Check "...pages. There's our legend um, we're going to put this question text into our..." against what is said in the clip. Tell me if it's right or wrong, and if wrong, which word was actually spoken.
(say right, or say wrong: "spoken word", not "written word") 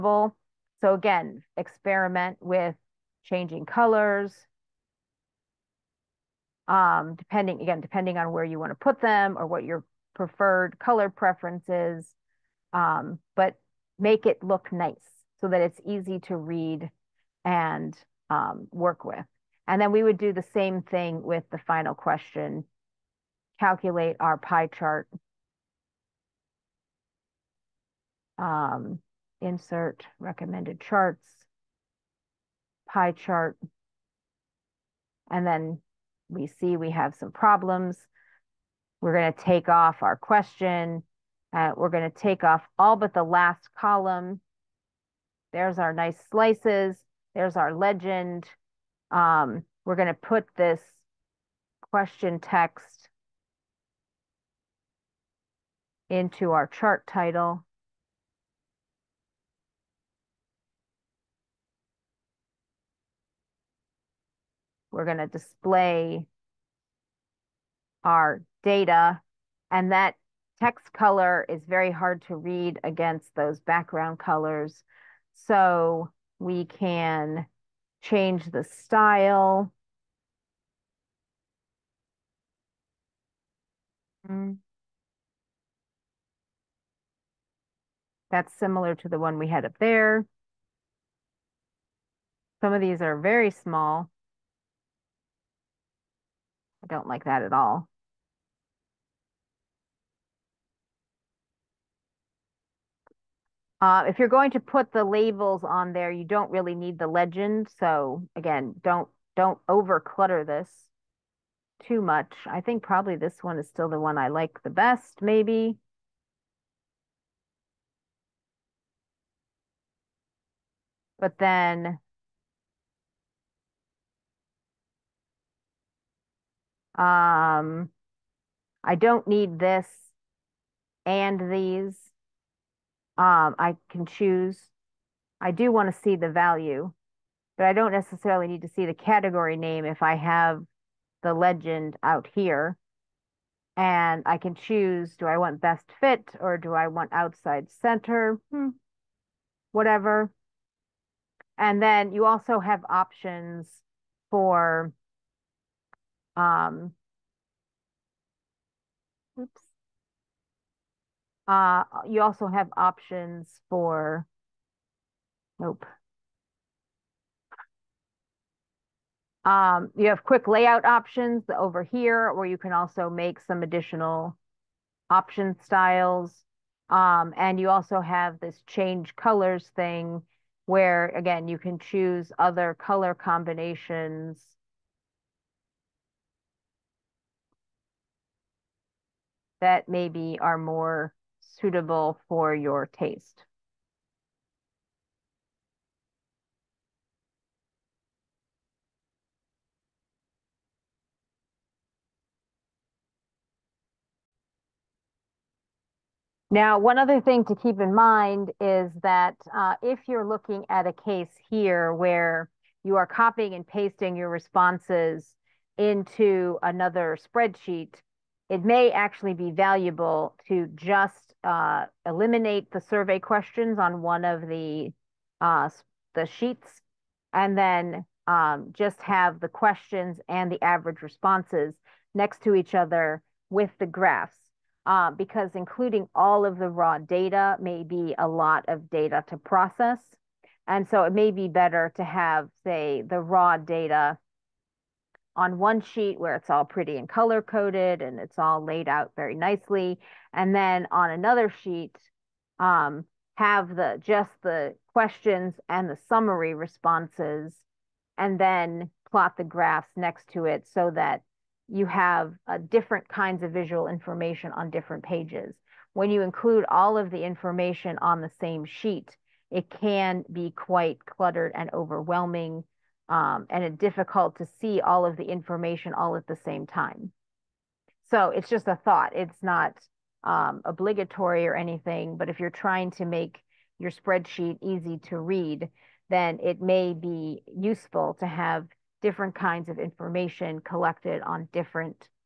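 wrong: "slices", not "pages".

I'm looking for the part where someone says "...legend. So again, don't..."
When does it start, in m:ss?
1:47.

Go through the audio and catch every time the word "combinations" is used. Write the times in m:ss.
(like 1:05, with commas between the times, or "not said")
3:03.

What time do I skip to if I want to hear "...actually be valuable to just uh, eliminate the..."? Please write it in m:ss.
3:38.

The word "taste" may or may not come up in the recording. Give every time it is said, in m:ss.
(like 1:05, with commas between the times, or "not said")
3:12.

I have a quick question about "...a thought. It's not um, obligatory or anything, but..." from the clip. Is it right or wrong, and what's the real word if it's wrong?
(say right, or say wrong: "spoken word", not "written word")
right.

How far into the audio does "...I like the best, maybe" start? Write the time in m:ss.
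1:54.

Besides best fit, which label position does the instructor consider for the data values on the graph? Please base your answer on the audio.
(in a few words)
Outside center.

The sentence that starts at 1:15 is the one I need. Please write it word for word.
So we can change the style.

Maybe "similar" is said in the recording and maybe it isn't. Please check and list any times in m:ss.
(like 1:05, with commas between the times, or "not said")
1:28.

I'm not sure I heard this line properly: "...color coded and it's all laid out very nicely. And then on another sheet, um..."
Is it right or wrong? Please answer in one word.
right.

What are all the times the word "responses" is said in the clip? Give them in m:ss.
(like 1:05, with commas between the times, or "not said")
3:34, 3:51, 4:16.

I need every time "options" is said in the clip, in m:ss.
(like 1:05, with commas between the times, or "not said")
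2:32, 2:42, 2:50, 2:55.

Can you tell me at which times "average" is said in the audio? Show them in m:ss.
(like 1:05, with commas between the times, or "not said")
3:50.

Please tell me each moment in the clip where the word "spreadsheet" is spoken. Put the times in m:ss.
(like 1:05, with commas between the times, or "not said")
3:37, 4:43.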